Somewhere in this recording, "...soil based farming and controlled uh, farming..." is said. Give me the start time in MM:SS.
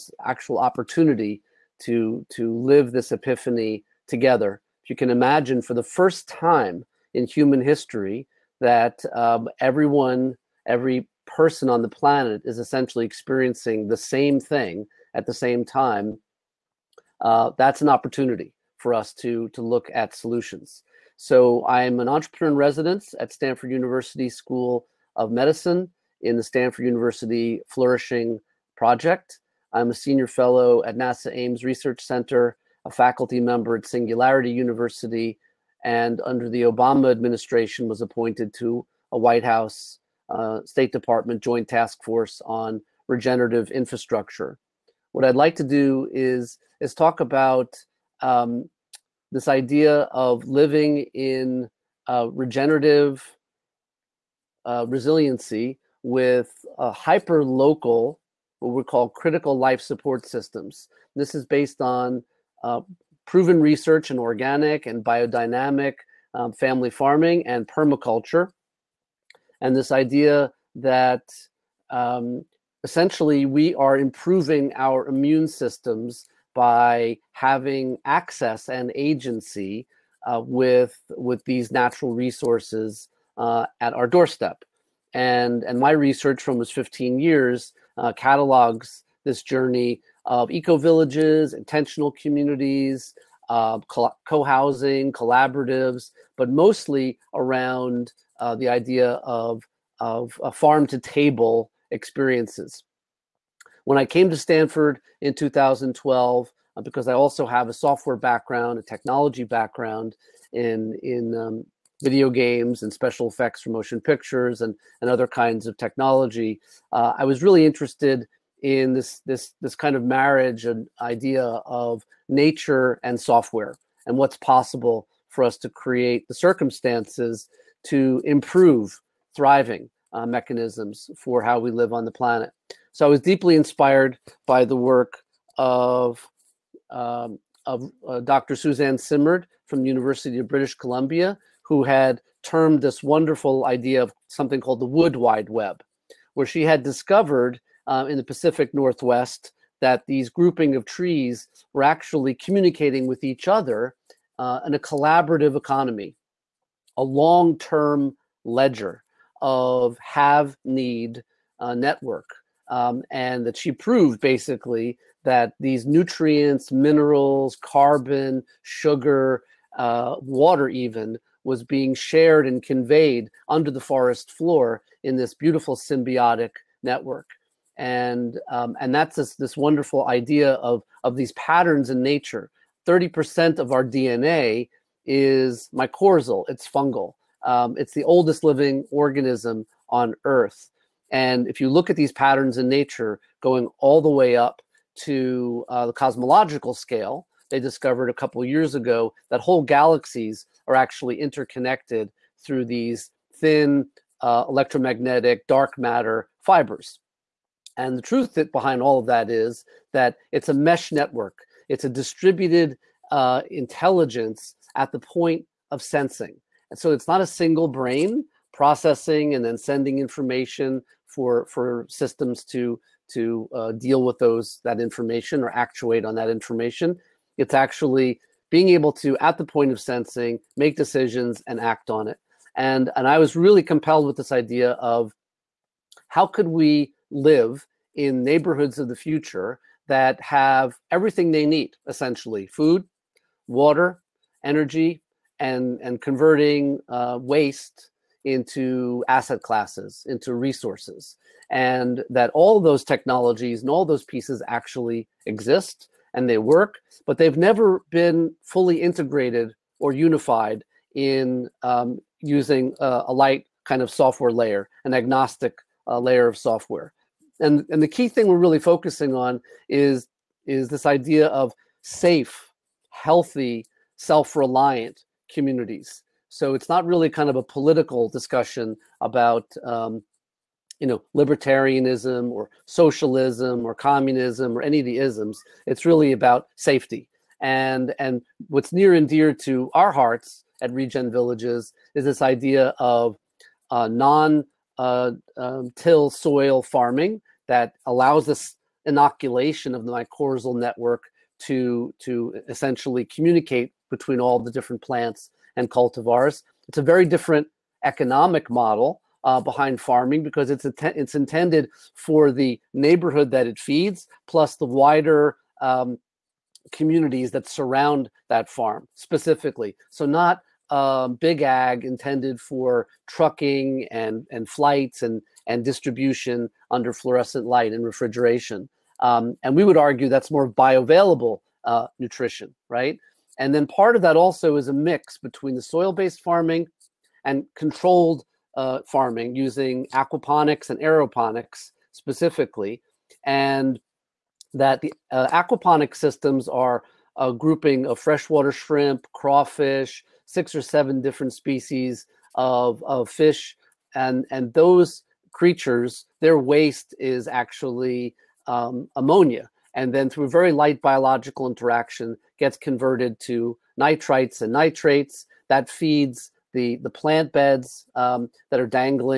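05:35.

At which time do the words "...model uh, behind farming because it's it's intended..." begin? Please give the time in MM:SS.
05:08.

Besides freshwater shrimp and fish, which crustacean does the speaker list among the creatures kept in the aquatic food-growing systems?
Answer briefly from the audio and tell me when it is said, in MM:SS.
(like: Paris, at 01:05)
crawfish, at 05:49.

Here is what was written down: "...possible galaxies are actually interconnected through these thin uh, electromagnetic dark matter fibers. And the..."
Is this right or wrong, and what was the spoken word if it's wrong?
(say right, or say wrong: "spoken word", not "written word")
wrong: "whole", not "possible".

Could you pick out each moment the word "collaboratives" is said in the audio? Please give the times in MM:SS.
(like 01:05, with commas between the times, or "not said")
01:35, 02:34.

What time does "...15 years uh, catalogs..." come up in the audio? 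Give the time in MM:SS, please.
01:26.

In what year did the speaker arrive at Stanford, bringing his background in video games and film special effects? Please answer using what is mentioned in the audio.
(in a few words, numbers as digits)
2012.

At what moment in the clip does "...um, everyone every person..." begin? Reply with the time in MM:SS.
00:09.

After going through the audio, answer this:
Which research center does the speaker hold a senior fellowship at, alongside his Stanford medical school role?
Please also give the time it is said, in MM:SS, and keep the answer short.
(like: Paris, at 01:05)
NASA Ames Research Center, at 00:30.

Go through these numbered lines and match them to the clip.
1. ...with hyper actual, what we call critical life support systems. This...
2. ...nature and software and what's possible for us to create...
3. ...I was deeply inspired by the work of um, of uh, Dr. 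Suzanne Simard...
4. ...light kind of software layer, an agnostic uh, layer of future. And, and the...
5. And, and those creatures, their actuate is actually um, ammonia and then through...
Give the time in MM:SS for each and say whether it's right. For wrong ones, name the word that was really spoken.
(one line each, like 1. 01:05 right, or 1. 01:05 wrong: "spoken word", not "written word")
1. 00:56 wrong: "local", not "actual"
2. 02:02 right
3. 02:13 right
4. 04:23 wrong: "software", not "future"
5. 05:53 wrong: "waste", not "actuate".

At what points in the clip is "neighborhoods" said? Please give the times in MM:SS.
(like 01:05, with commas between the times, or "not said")
03:58, 05:12.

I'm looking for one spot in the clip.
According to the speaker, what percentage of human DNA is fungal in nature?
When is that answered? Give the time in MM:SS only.
03:02.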